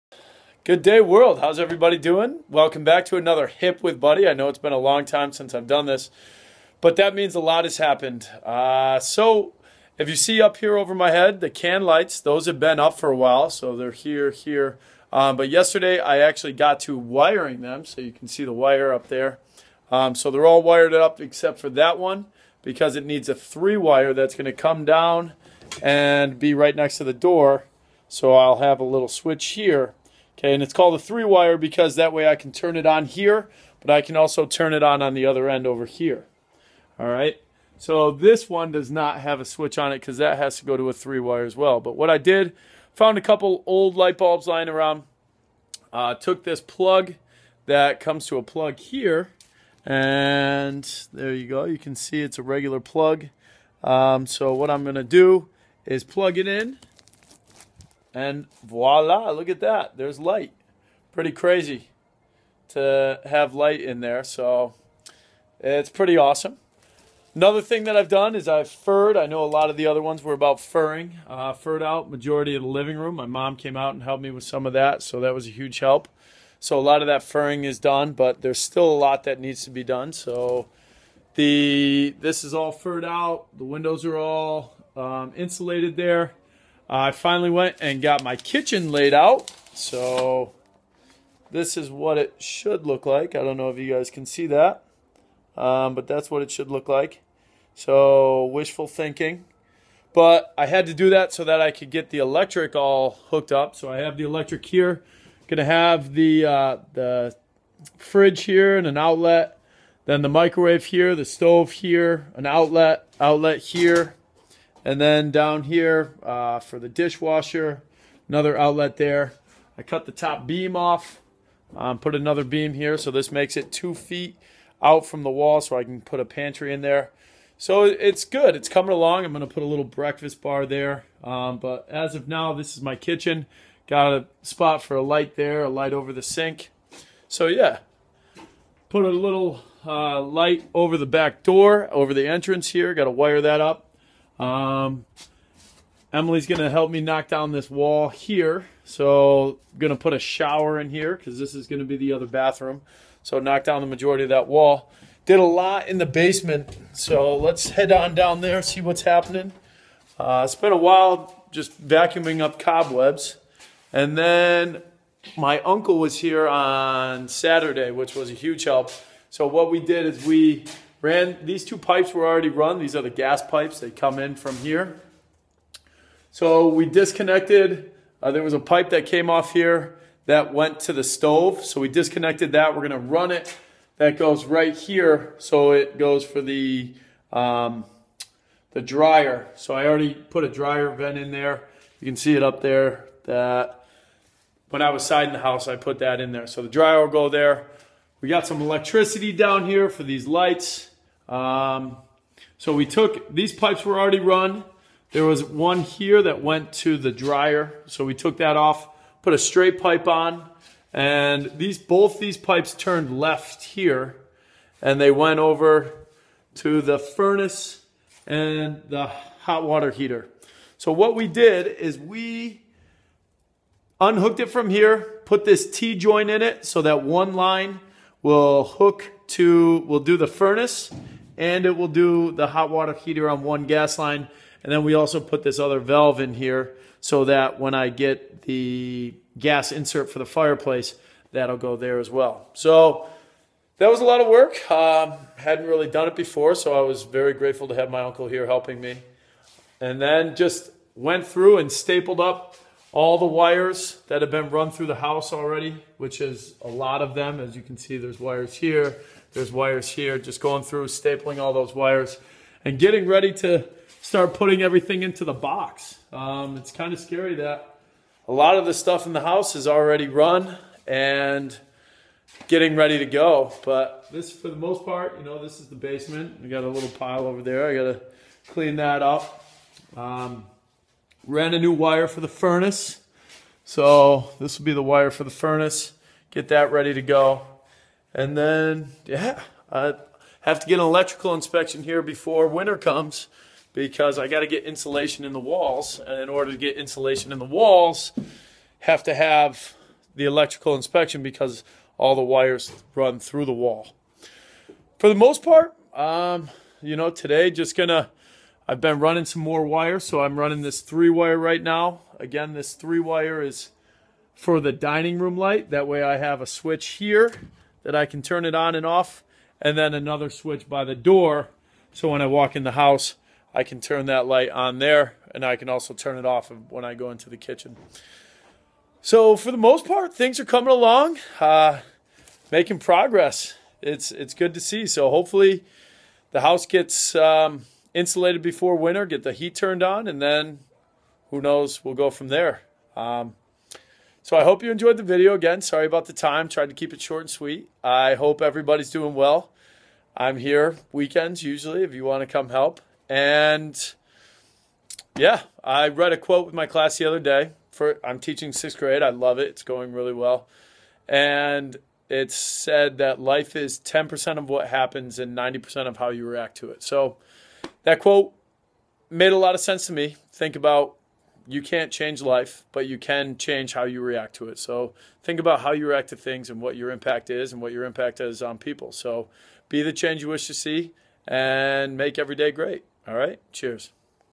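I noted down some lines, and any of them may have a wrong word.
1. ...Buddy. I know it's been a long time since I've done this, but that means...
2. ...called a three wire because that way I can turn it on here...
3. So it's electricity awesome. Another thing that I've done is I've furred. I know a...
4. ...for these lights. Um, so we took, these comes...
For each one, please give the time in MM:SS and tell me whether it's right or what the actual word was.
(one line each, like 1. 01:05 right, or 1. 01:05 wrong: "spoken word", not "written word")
1. 00:03 right
2. 00:30 right
3. 01:04 wrong: "pretty", not "electricity"
4. 03:19 wrong: "pipes", not "comes".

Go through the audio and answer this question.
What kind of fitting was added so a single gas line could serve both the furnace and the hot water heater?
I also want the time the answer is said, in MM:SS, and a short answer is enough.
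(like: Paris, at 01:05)
T-joint, at 03:45.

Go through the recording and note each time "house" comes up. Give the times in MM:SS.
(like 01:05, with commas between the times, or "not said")
03:15, 04:14, 04:29, 05:22, 05:36.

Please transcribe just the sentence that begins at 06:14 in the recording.
So think about how you react to things and what your impact is and what your impact is on people.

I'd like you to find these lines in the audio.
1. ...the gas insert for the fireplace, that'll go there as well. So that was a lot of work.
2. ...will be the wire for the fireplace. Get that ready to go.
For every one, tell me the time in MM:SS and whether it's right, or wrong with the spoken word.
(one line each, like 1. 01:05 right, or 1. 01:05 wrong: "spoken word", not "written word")
1. 03:58 right
2. 04:44 wrong: "furnace", not "fireplace".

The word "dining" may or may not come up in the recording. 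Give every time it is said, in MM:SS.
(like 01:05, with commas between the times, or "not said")
05:14.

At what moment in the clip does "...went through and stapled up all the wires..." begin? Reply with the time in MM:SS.
04:10.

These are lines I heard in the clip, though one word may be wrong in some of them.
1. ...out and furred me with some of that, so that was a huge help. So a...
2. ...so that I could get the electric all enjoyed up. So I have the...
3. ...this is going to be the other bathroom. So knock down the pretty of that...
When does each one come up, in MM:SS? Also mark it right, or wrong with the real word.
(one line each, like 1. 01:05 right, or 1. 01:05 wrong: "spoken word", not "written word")
1. 01:13 wrong: "helped", not "furred"
2. 01:41 wrong: "hooked", not "enjoyed"
3. 02:31 wrong: "majority", not "pretty".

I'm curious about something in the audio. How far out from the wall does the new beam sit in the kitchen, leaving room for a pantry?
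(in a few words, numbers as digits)
two feet.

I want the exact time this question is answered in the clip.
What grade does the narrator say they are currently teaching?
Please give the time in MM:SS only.
05:58.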